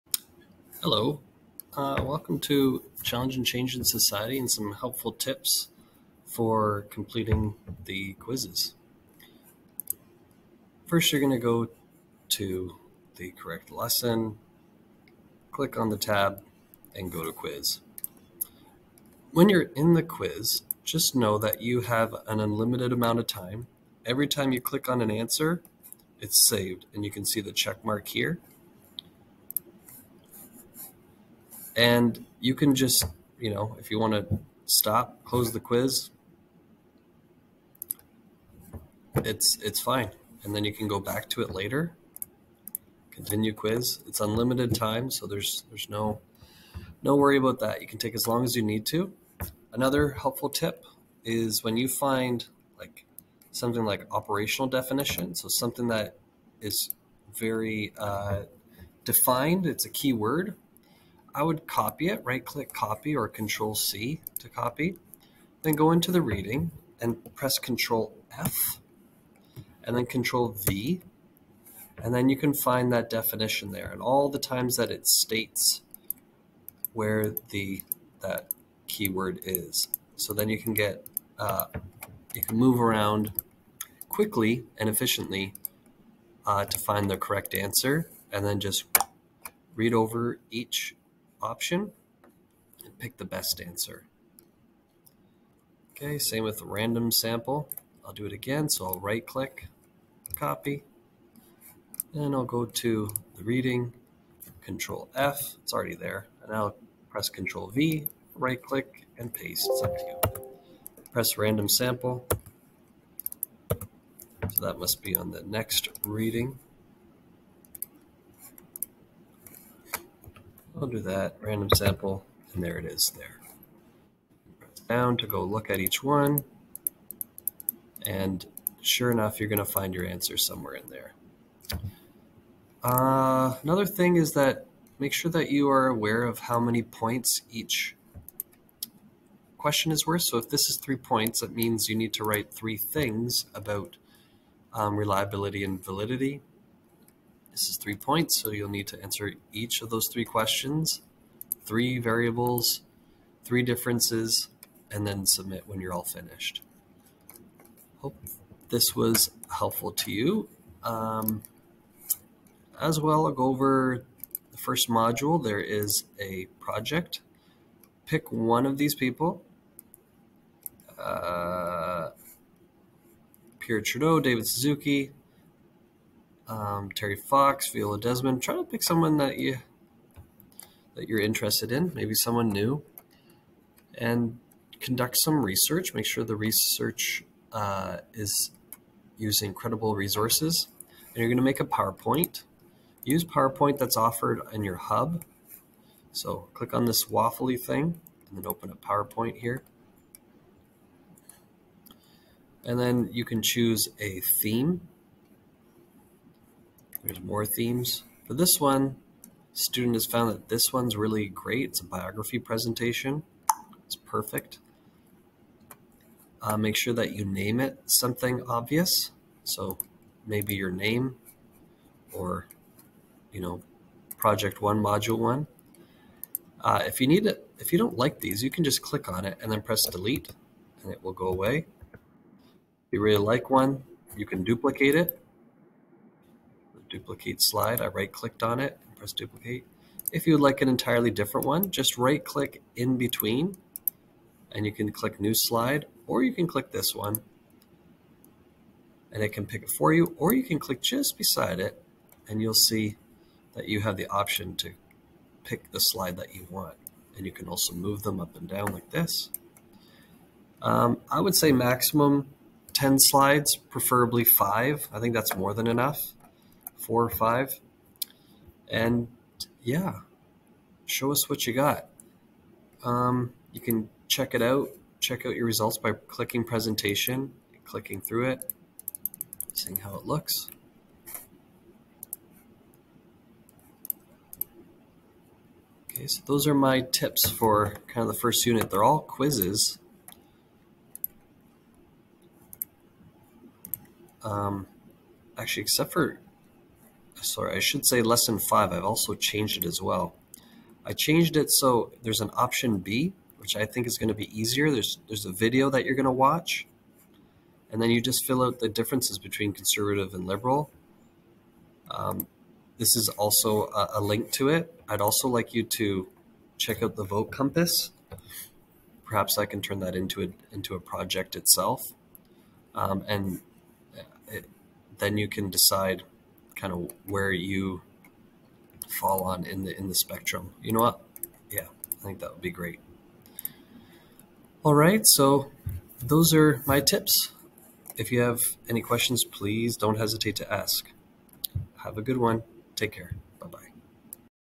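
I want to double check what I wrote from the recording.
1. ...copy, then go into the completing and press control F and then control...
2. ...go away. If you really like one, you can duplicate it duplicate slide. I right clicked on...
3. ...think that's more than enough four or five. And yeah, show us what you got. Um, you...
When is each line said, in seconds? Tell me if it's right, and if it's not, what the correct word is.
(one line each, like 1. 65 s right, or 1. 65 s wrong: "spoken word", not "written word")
1. 64 s wrong: "reading", not "completing"
2. 231 s right
3. 264 s right.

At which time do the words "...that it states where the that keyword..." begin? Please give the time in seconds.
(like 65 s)
74 s.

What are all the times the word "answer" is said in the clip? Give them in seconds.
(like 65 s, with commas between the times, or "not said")
25 s, 87 s, 93 s, 130 s, 149 s.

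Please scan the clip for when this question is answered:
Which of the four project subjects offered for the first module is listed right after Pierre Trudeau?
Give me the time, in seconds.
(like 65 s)
174 s.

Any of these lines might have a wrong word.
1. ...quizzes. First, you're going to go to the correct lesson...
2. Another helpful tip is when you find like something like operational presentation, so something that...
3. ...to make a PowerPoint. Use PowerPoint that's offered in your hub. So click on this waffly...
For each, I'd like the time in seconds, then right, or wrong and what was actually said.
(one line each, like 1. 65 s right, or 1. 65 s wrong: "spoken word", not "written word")
1. 8 s right
2. 49 s wrong: "definition", not "presentation"
3. 191 s right.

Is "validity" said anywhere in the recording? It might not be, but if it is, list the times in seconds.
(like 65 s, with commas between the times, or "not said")
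145 s.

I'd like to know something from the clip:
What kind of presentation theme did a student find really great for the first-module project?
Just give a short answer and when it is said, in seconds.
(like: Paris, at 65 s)
Biography presentation, at 211 s.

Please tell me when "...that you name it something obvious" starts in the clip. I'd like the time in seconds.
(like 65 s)
216 s.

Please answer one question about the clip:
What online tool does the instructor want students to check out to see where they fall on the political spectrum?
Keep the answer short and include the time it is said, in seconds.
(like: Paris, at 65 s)
Vote Compass, at 317 s.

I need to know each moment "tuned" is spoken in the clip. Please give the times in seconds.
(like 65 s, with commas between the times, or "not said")
not said.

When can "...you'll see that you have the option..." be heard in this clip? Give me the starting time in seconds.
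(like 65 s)
252 s.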